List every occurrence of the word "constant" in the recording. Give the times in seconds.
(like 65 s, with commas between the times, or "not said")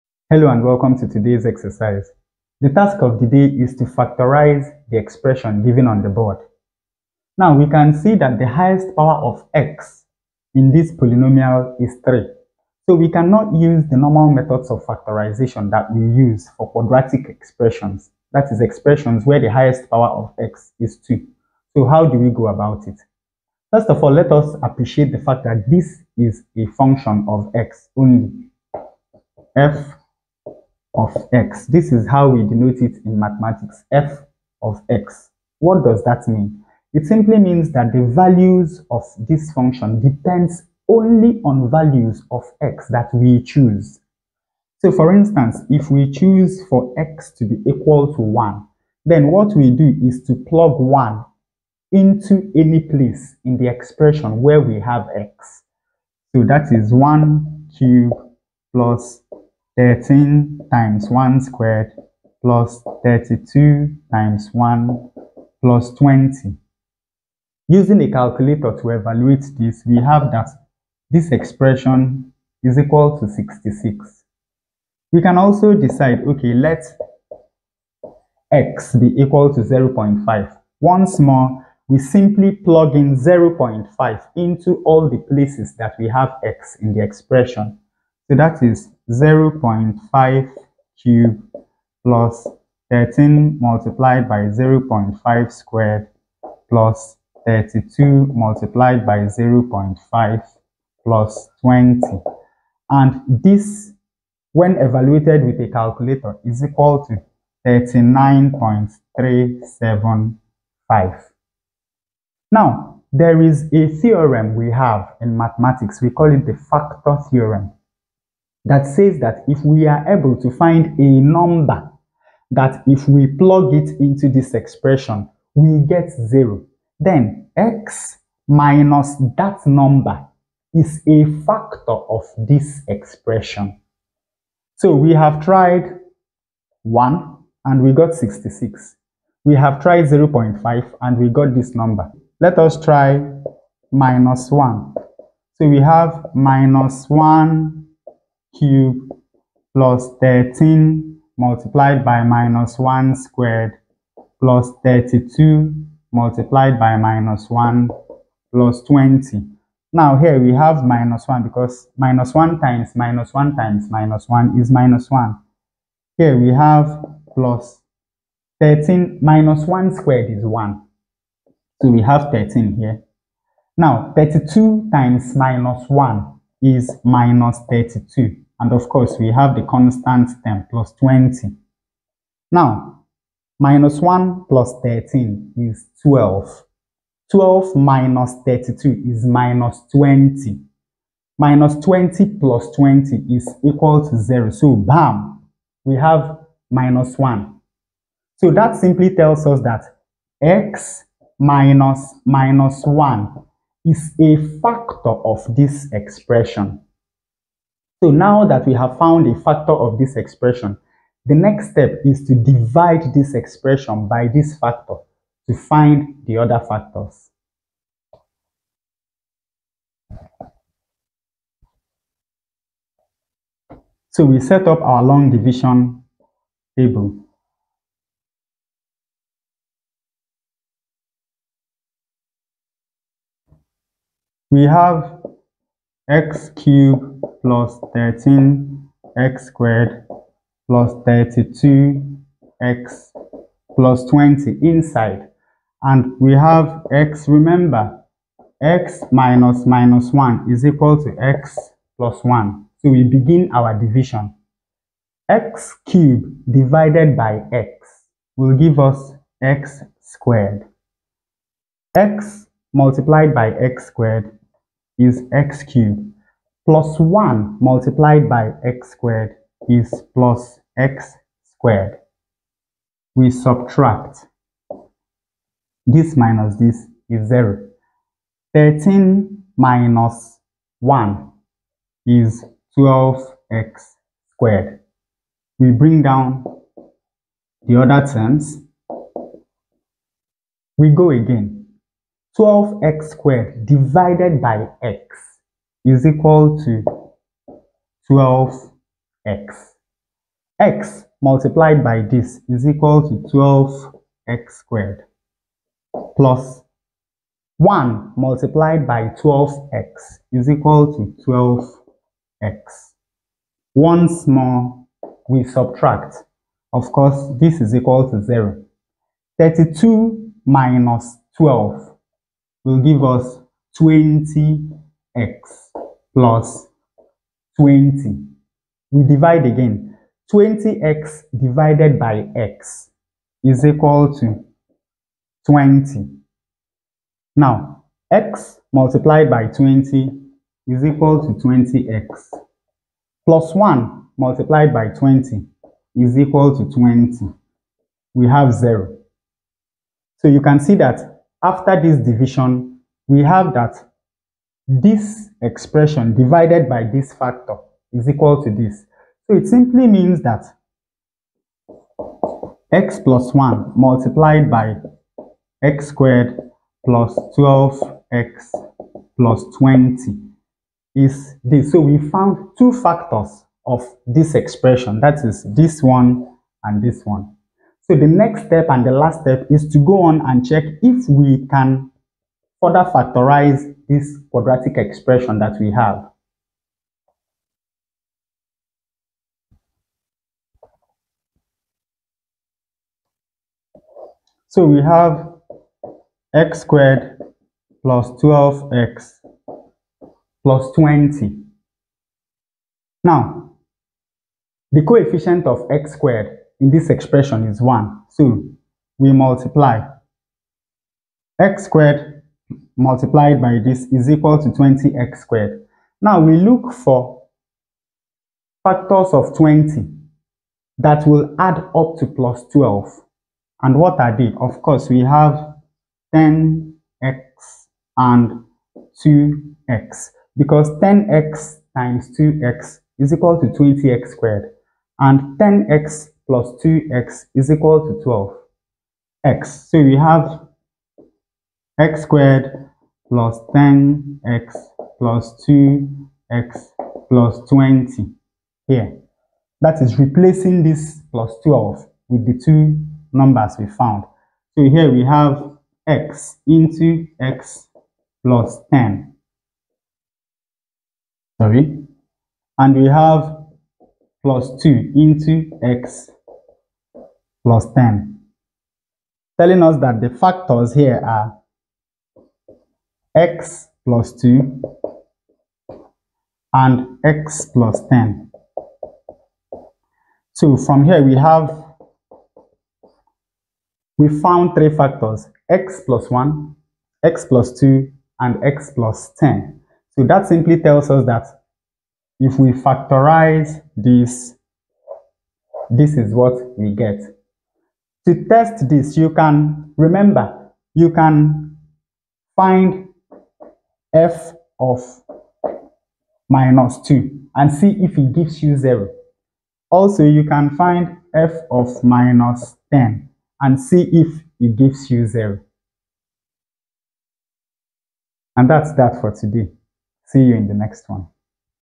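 179 s.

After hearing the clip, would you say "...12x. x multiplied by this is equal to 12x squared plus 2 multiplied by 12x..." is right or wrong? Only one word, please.
wrong.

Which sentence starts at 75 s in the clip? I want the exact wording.
We can also decide, okay, let x be equal to 0.5.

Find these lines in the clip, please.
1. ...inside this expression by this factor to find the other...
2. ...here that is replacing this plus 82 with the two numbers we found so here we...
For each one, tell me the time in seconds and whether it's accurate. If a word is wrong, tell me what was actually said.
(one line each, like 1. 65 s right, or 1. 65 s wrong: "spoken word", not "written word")
1. 212 s wrong: "divide", not "inside"
2. 448 s wrong: "12", not "82".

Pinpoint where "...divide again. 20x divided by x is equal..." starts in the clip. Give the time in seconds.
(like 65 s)
329 s.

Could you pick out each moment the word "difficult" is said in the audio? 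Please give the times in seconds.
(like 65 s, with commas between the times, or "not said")
not said.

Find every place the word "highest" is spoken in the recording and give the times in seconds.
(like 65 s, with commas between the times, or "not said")
8 s, 19 s.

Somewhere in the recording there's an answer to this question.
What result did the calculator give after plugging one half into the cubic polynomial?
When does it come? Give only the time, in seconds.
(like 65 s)
107 s.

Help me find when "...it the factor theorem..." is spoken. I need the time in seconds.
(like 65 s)
116 s.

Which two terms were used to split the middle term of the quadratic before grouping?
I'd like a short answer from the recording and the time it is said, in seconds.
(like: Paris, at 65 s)
10x and 2x, at 426 s.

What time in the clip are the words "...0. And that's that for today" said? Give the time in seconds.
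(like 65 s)
515 s.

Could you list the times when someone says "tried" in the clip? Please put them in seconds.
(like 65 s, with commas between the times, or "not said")
135 s, 139 s.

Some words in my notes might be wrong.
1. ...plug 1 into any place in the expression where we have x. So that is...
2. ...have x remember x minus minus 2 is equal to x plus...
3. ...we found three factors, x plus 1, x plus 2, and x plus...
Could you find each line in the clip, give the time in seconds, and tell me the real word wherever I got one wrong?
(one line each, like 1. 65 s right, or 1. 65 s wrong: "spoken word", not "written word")
1. 50 s right
2. 246 s wrong: "1", not "2"
3. 483 s right.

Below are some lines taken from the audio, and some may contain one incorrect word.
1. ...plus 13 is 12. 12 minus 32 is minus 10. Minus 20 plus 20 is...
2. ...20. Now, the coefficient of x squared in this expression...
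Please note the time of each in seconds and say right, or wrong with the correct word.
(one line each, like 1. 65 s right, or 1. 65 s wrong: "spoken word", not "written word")
1. 184 s wrong: "20", not "10"
2. 400 s right.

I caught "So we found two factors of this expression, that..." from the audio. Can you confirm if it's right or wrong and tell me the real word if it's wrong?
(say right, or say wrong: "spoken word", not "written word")
right.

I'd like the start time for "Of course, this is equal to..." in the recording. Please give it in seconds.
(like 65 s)
316 s.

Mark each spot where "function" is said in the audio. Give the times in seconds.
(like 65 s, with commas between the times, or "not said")
26 s, 39 s.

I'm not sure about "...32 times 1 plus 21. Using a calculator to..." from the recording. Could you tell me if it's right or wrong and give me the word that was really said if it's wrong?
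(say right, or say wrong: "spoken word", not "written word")
wrong: "20", not "21".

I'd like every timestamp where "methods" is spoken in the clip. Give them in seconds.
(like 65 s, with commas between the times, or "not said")
14 s.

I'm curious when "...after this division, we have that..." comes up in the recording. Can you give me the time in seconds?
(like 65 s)
351 s.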